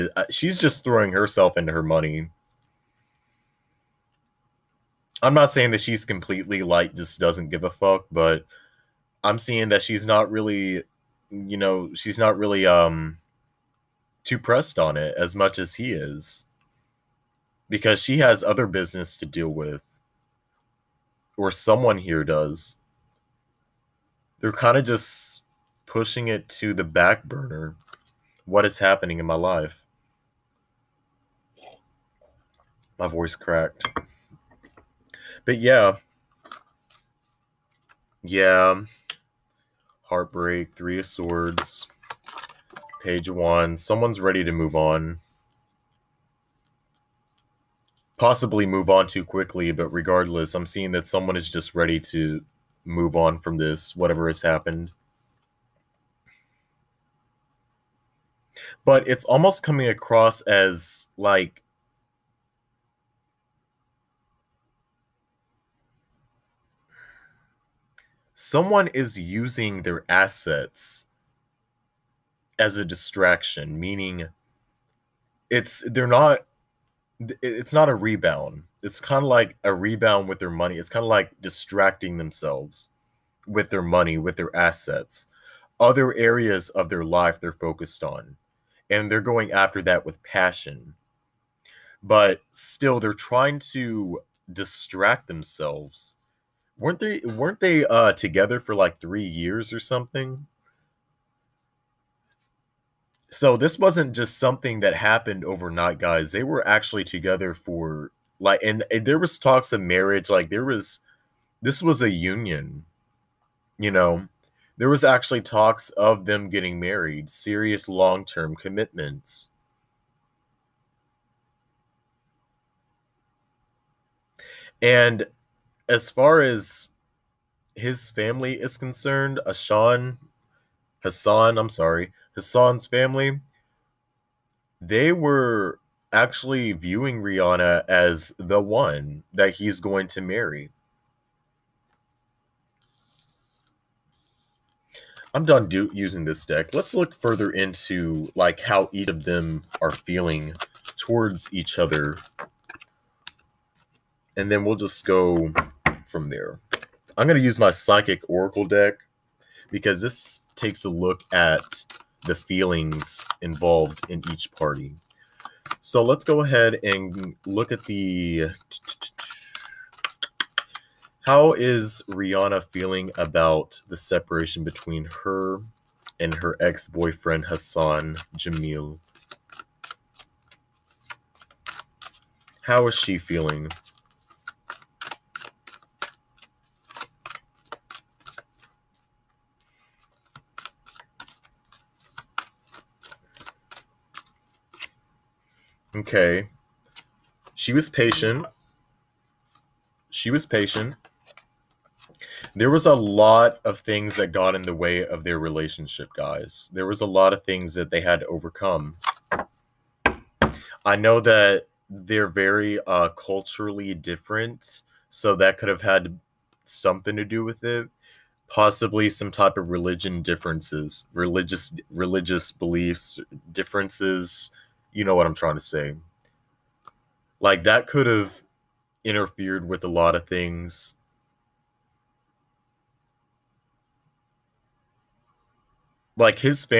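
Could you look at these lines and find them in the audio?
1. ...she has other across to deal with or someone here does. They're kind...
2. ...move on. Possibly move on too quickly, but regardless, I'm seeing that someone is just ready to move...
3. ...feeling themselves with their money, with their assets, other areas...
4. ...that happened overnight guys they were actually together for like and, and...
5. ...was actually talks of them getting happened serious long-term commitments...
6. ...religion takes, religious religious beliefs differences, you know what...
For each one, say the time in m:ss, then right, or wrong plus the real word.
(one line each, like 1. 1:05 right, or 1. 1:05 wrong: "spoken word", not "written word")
1. 0:18 wrong: "business", not "across"
2. 0:44 right
3. 1:21 wrong: "distracting", not "feeling"
4. 1:44 right
5. 1:54 wrong: "married", not "happened"
6. 3:39 wrong: "differences", not "takes".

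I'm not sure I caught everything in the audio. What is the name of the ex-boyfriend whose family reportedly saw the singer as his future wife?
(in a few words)
Hassan Jameel.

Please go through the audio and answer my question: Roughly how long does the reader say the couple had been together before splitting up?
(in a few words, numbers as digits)
3 years.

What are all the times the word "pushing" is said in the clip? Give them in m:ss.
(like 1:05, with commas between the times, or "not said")
0:25.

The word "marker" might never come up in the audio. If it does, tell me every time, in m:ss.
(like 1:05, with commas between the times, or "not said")
not said.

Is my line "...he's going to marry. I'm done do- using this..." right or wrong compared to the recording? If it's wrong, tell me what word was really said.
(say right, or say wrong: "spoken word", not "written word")
right.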